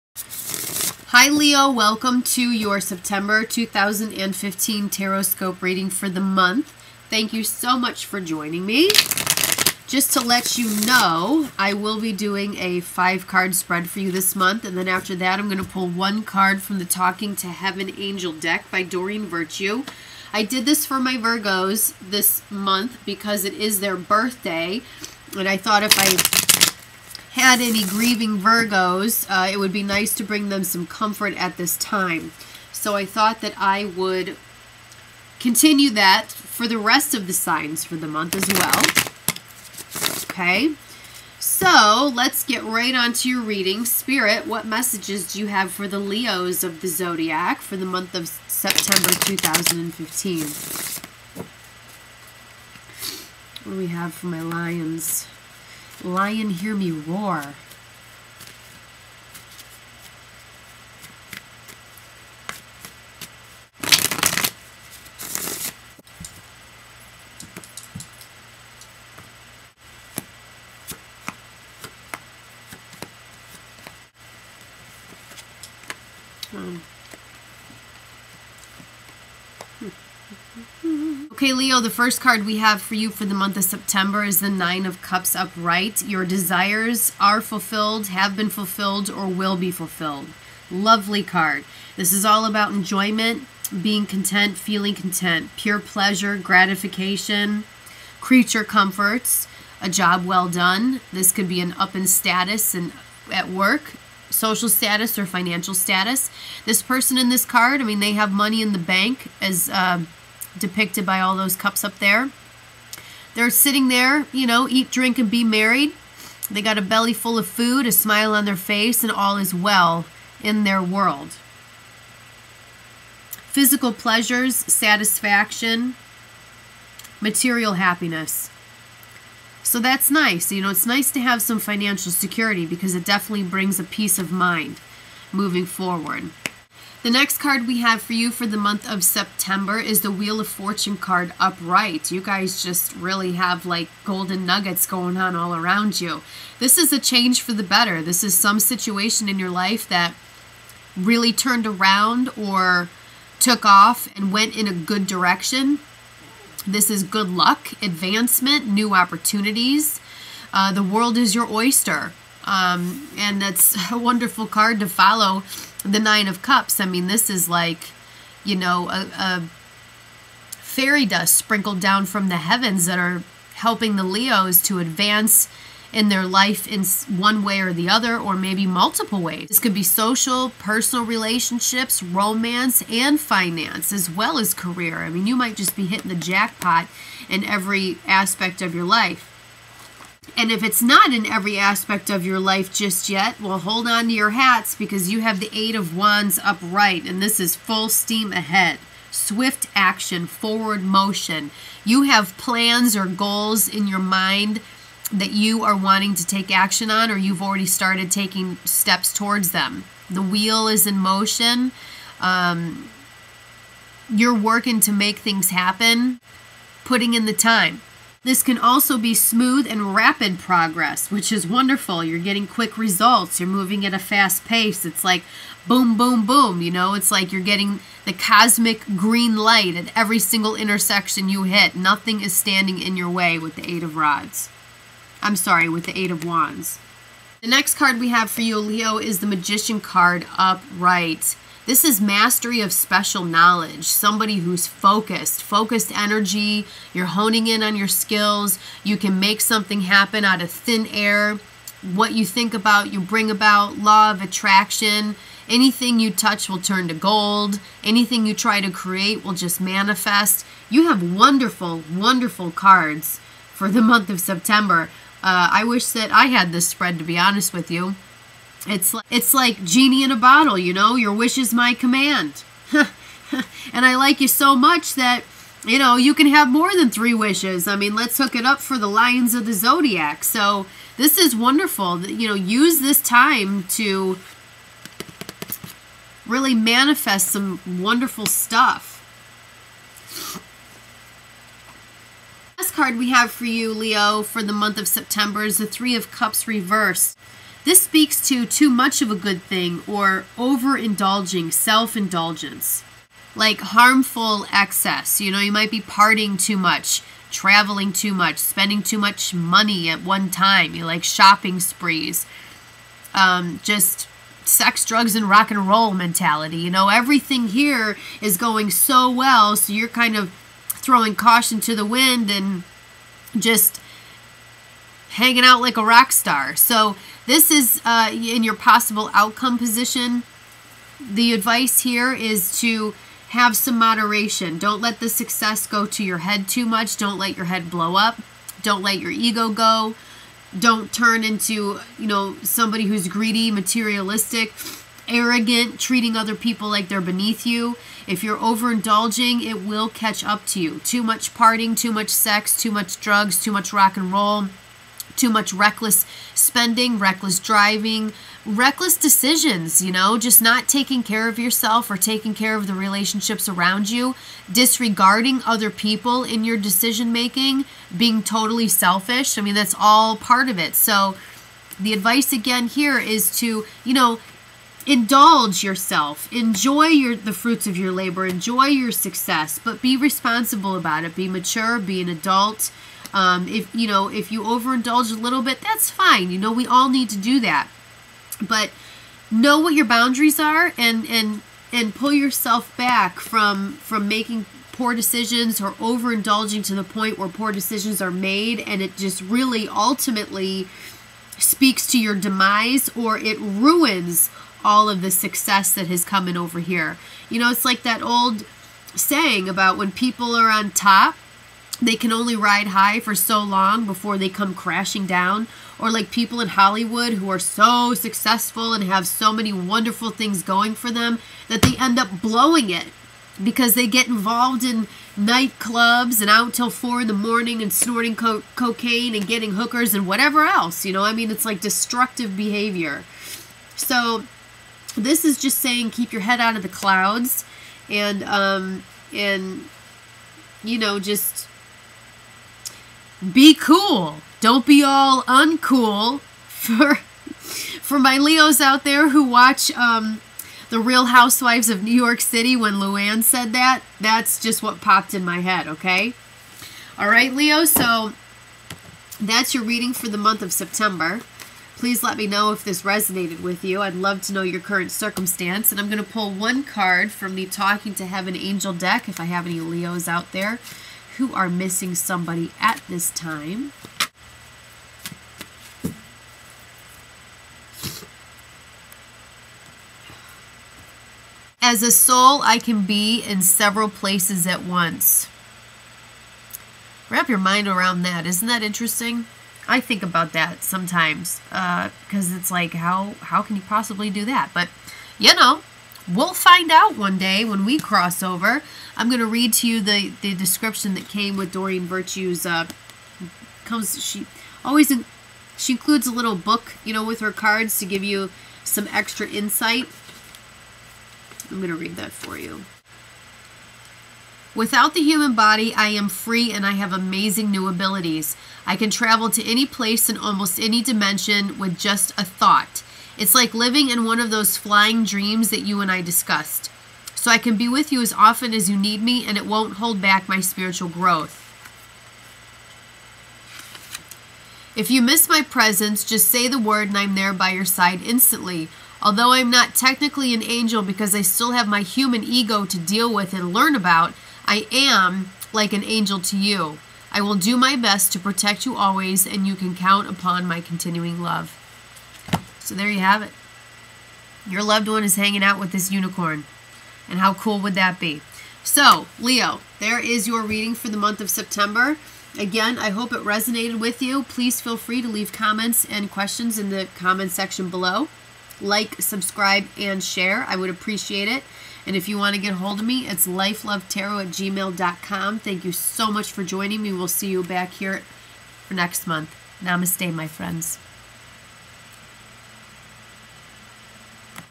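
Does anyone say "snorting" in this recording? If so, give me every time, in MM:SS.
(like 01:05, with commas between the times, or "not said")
07:07.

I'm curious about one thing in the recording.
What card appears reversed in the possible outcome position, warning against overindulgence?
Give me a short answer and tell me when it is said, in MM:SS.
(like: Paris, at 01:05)
Three of Cups, at 04:55.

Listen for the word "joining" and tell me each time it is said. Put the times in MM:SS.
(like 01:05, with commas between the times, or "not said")
00:08, 09:36.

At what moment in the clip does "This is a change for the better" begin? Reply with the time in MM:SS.
02:26.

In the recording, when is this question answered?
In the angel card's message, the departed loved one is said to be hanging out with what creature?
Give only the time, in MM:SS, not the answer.
09:15.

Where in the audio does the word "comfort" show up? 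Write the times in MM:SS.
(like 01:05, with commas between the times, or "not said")
00:30, 01:38.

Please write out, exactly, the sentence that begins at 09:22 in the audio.
Again, I hope it resonated with you.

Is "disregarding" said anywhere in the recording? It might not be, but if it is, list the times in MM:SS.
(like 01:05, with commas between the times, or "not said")
06:04.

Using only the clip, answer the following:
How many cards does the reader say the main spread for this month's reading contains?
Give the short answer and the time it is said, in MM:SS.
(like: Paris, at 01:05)
5, at 00:12.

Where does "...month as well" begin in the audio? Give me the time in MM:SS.
00:38.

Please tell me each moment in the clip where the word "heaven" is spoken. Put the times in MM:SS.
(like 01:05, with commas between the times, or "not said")
00:17, 02:52, 07:48.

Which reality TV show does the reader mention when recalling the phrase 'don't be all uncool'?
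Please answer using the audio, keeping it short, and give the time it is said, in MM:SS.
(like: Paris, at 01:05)
Real Housewives of New York City, at 07:30.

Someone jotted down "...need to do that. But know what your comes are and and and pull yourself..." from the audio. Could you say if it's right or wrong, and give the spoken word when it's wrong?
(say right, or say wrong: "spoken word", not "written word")
wrong: "boundaries", not "comes".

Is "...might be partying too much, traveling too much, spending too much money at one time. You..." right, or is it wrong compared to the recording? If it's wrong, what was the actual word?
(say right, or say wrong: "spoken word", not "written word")
right.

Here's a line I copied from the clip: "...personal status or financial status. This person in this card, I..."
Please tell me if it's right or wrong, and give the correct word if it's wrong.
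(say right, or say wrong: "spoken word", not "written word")
wrong: "social", not "personal".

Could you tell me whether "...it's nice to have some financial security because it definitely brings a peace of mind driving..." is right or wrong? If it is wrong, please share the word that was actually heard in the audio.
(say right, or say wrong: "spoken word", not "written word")
wrong: "moving", not "driving".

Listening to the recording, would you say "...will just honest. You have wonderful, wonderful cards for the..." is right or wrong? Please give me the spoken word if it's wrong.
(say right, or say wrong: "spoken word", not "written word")
wrong: "manifest", not "honest".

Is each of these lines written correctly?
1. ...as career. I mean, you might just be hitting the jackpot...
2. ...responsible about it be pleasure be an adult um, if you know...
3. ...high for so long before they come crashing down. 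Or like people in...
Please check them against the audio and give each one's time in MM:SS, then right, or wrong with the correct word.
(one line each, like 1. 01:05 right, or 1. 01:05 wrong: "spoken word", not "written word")
1. 03:04 right
2. 06:19 wrong: "mature", not "pleasure"
3. 06:52 right.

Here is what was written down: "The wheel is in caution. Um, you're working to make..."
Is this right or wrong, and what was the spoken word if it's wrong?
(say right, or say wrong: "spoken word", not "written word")
wrong: "motion", not "caution".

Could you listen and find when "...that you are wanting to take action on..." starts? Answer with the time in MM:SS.
03:25.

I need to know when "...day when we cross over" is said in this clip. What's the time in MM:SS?
08:17.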